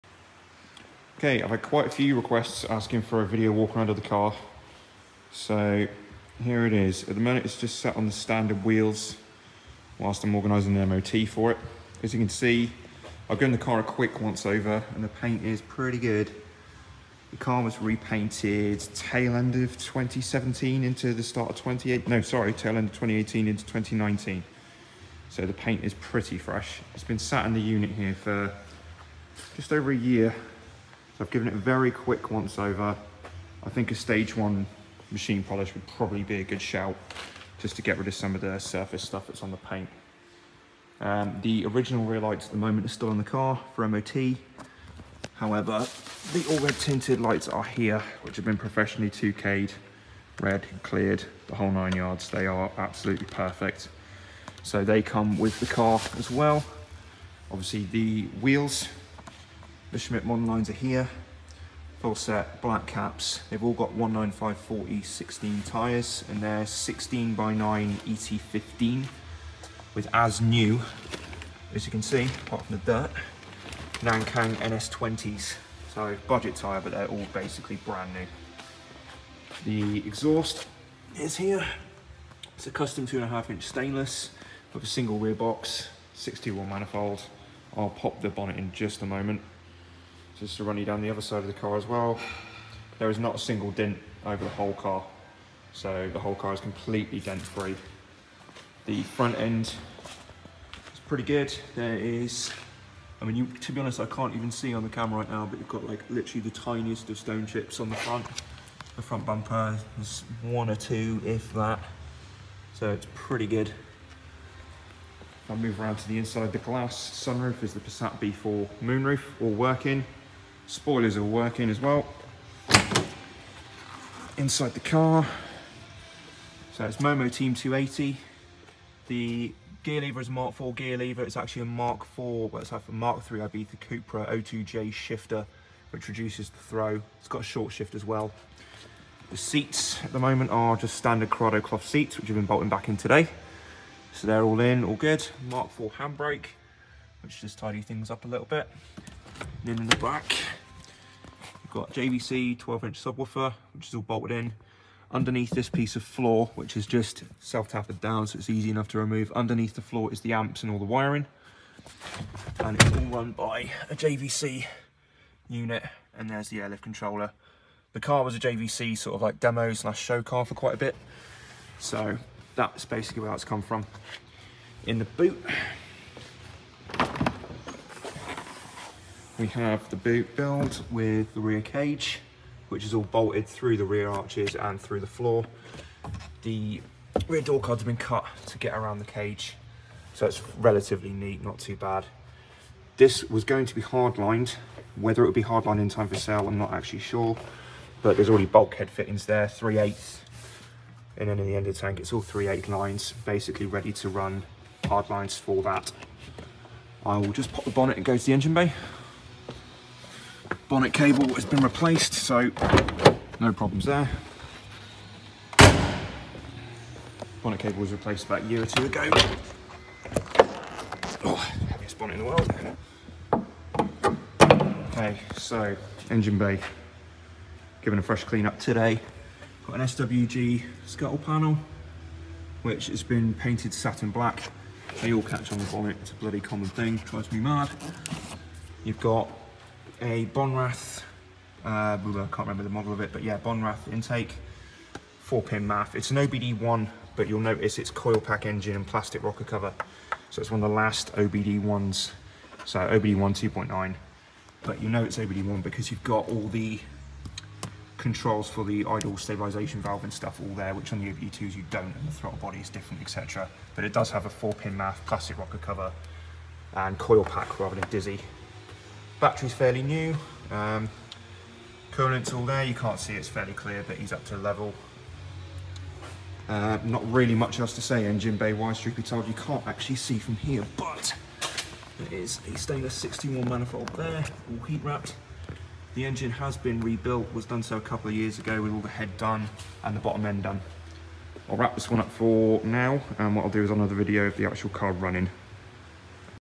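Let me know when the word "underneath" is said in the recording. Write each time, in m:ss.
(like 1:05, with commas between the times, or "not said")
2:35, 2:39.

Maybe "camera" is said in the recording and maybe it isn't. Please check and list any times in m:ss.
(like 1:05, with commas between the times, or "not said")
1:44.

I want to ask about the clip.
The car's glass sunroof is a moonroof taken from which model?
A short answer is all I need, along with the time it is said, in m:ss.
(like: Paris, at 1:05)
Passat B4, at 1:57.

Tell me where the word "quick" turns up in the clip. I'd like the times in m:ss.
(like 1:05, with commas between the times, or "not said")
0:13, 0:31.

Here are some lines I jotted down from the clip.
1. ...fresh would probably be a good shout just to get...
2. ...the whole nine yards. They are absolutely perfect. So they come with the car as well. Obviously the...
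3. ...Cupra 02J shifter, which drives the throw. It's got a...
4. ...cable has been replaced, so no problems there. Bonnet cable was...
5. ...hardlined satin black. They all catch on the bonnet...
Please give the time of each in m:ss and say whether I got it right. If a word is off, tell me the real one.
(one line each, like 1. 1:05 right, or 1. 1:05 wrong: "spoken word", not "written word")
1. 0:35 wrong: "polish", not "fresh"
2. 0:51 right
3. 2:13 wrong: "reduces", not "drives"
4. 3:30 right
5. 3:53 wrong: "painted", not "hardlined".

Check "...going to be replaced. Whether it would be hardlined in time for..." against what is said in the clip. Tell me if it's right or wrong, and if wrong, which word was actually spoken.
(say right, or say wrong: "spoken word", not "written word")
wrong: "hardlined", not "replaced".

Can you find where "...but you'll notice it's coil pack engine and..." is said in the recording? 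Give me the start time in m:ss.
4:07.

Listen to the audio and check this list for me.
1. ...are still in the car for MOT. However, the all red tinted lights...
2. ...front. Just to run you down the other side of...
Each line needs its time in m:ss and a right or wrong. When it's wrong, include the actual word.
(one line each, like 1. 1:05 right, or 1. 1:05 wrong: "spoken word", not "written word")
1. 0:42 right
2. 1:29 wrong: "moment", not "front".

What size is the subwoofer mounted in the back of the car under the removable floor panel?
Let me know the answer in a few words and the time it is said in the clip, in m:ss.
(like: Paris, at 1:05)
12 inch, at 2:32.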